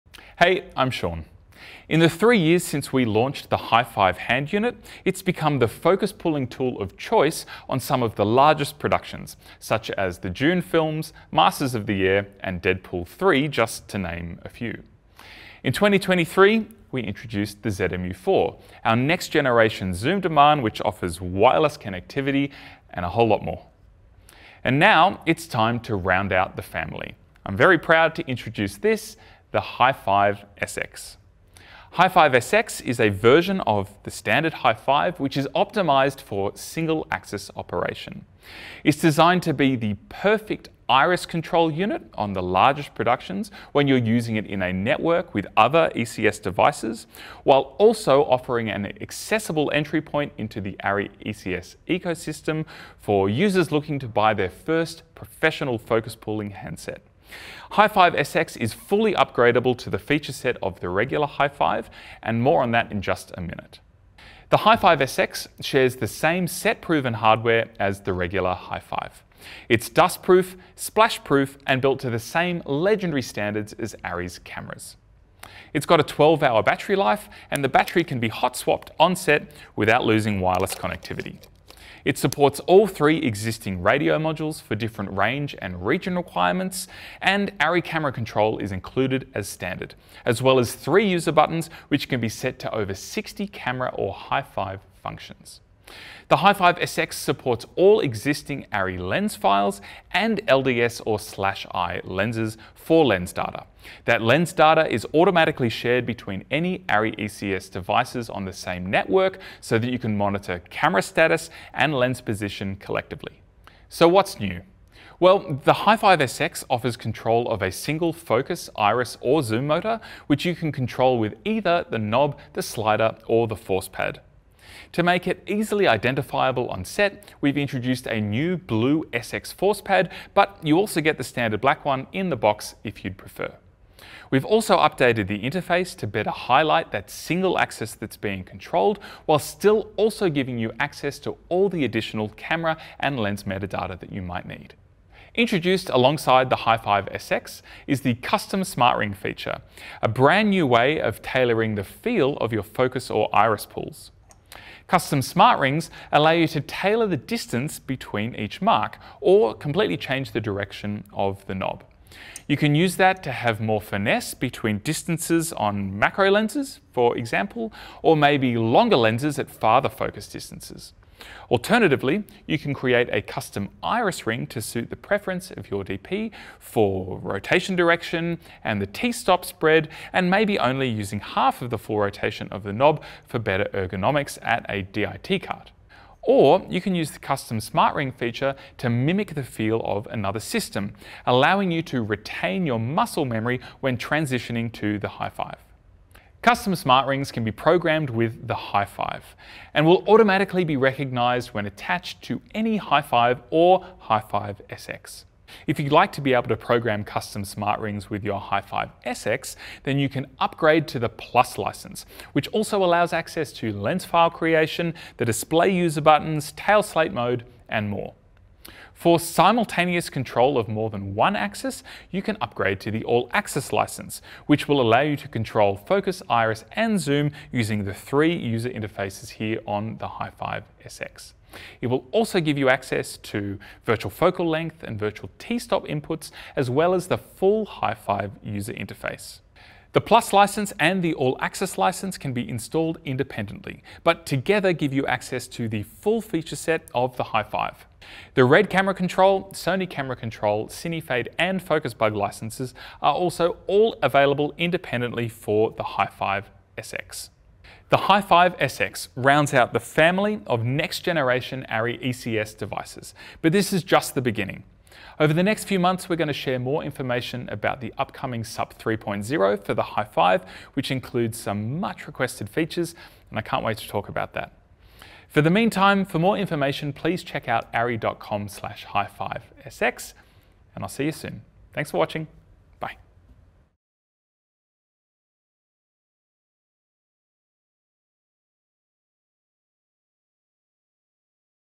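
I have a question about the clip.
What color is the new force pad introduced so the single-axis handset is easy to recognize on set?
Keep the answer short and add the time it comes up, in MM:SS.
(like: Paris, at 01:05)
Blue, at 02:08.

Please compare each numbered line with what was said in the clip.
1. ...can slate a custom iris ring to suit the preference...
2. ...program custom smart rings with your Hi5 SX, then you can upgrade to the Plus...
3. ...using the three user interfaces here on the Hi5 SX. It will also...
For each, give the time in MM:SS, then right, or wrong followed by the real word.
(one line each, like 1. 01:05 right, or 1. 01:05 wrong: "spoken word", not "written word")
1. 02:52 wrong: "create", not "slate"
2. 03:26 right
3. 03:47 right.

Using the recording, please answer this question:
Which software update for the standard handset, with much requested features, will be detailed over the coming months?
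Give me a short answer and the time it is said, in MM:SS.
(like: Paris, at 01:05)
SUP 3.0, at 04:28.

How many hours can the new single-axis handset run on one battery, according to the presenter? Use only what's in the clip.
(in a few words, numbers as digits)
12 hours.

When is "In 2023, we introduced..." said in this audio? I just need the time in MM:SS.
00:15.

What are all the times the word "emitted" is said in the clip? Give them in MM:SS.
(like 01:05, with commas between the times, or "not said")
not said.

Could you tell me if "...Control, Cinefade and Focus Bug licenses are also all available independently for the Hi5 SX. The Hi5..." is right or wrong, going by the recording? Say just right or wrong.
right.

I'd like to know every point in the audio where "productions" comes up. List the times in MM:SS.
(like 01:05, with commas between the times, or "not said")
00:08, 00:42.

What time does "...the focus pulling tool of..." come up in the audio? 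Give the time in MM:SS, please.
00:05.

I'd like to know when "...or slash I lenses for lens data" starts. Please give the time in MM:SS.
01:41.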